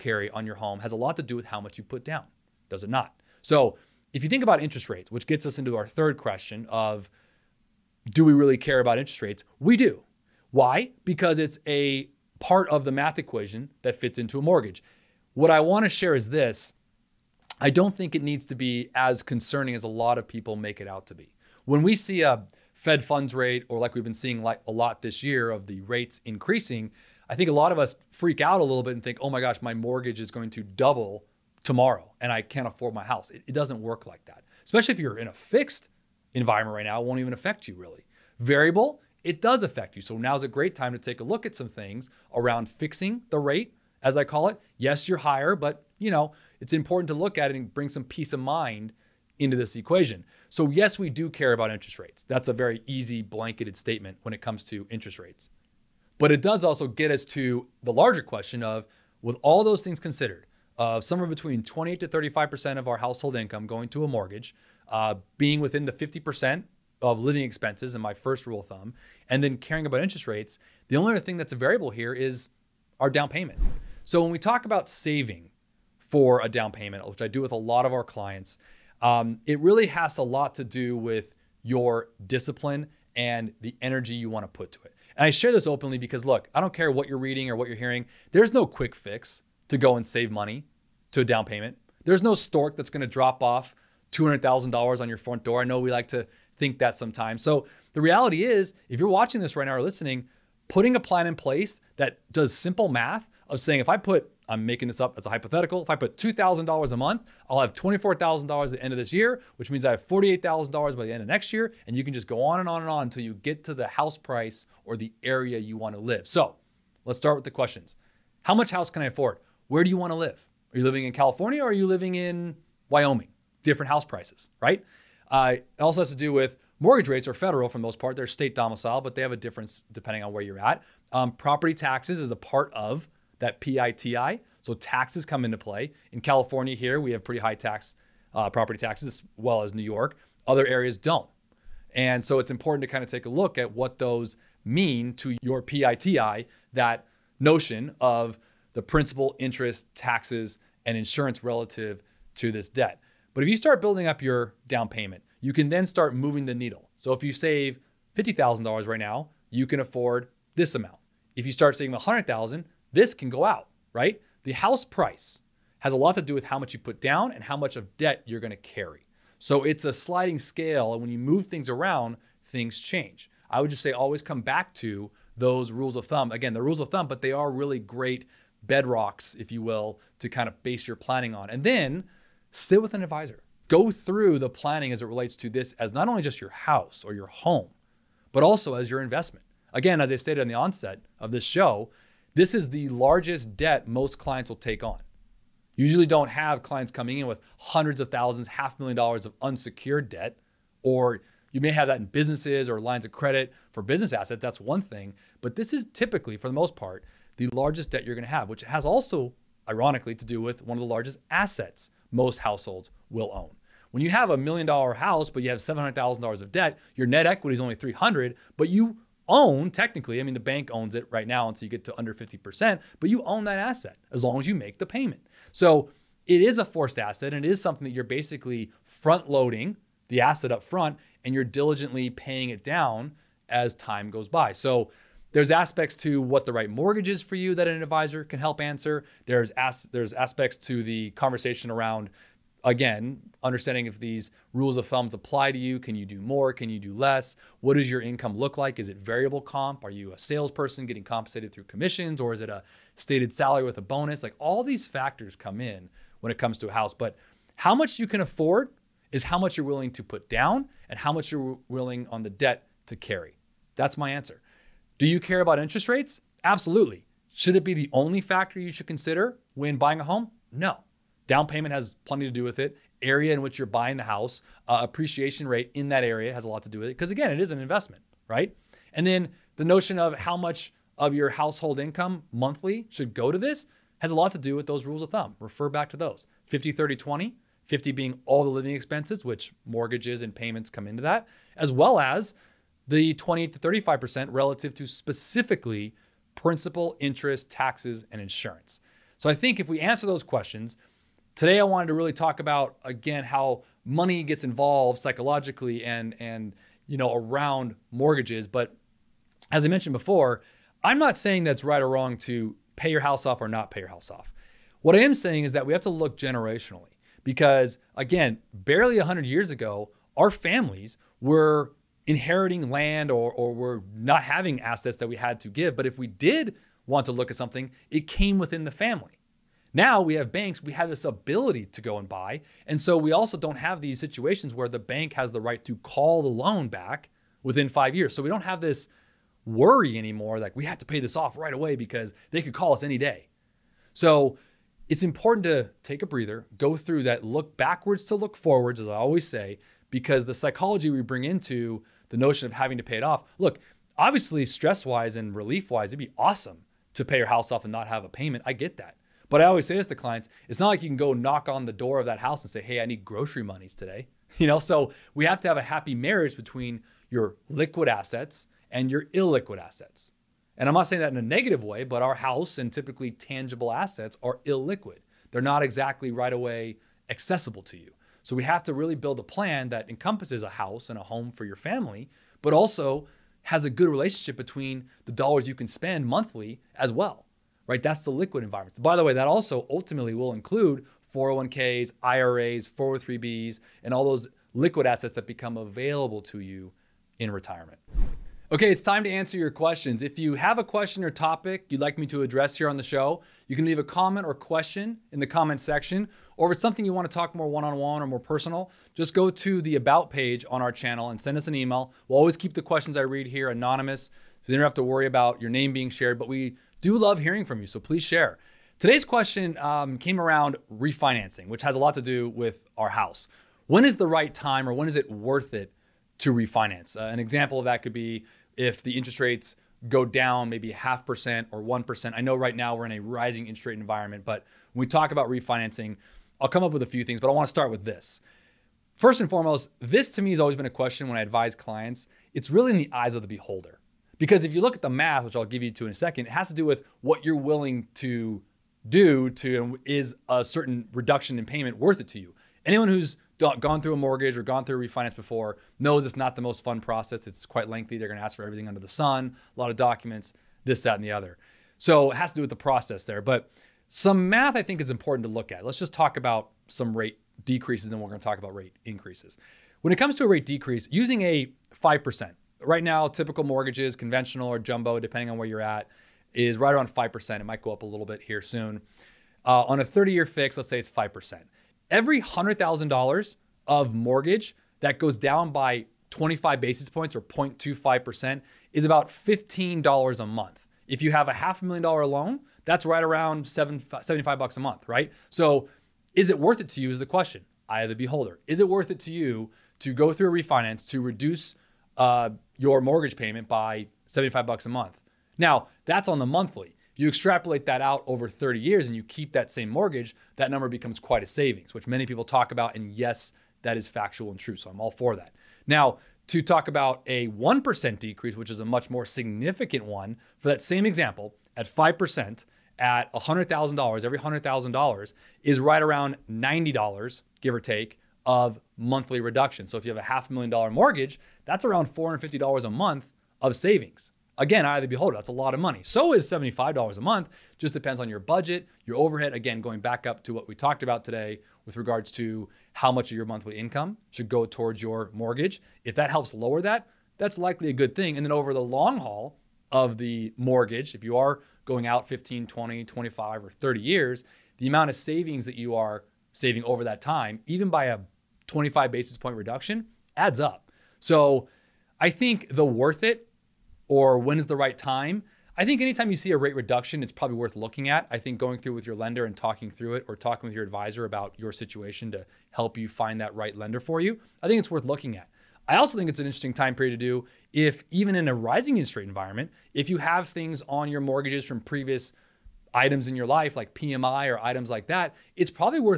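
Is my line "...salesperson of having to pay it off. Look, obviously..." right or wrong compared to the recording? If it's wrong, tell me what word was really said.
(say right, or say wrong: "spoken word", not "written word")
wrong: "notion", not "salesperson".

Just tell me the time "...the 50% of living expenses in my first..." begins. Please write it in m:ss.
1:05.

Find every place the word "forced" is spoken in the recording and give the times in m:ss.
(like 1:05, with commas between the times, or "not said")
3:46.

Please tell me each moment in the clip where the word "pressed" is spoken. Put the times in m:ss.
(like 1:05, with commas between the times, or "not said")
not said.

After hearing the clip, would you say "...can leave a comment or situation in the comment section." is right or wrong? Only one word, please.
wrong.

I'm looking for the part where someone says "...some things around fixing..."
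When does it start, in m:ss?
0:41.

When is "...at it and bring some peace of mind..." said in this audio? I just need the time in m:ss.
0:47.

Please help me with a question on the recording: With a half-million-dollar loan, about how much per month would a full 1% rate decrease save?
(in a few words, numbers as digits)
$450.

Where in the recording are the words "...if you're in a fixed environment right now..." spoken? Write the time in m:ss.
0:34.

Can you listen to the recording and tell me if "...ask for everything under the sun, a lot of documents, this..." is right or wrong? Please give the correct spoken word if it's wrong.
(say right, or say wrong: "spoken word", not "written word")
right.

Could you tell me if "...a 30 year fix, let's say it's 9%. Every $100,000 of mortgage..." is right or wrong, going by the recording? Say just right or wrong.
wrong.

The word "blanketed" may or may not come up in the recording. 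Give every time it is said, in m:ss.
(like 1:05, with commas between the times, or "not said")
0:53.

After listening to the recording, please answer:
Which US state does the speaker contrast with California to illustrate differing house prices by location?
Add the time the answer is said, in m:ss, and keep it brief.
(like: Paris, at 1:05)
Wyoming, at 2:02.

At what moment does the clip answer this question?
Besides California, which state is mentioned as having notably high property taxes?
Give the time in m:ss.
2:19.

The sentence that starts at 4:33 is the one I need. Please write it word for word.
Area in which you're buying the house, uh, appreciation rate in that area has a lot to do with it.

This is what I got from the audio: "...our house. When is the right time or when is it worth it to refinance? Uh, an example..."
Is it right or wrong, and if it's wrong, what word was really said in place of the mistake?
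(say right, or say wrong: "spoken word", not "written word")
right.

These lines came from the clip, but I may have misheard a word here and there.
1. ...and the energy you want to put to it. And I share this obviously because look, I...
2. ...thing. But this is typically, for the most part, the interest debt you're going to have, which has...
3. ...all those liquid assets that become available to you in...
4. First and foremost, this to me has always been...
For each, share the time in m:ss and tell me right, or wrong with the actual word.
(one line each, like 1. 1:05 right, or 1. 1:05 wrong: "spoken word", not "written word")
1. 1:23 wrong: "openly", not "obviously"
2. 3:24 wrong: "largest", not "interest"
3. 6:33 right
4. 7:18 right.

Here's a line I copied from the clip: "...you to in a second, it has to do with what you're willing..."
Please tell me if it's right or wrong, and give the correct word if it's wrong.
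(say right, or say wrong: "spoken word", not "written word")
right.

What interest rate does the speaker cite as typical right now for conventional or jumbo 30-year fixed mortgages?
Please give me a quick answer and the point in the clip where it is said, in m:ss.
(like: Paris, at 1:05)
5%, at 7:56.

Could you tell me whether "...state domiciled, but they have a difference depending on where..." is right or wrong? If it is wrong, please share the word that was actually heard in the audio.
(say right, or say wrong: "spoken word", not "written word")
right.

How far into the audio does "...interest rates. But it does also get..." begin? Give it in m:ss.
0:54.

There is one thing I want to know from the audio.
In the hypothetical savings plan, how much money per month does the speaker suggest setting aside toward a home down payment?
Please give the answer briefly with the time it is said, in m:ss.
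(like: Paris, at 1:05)
$2,000, at 1:46.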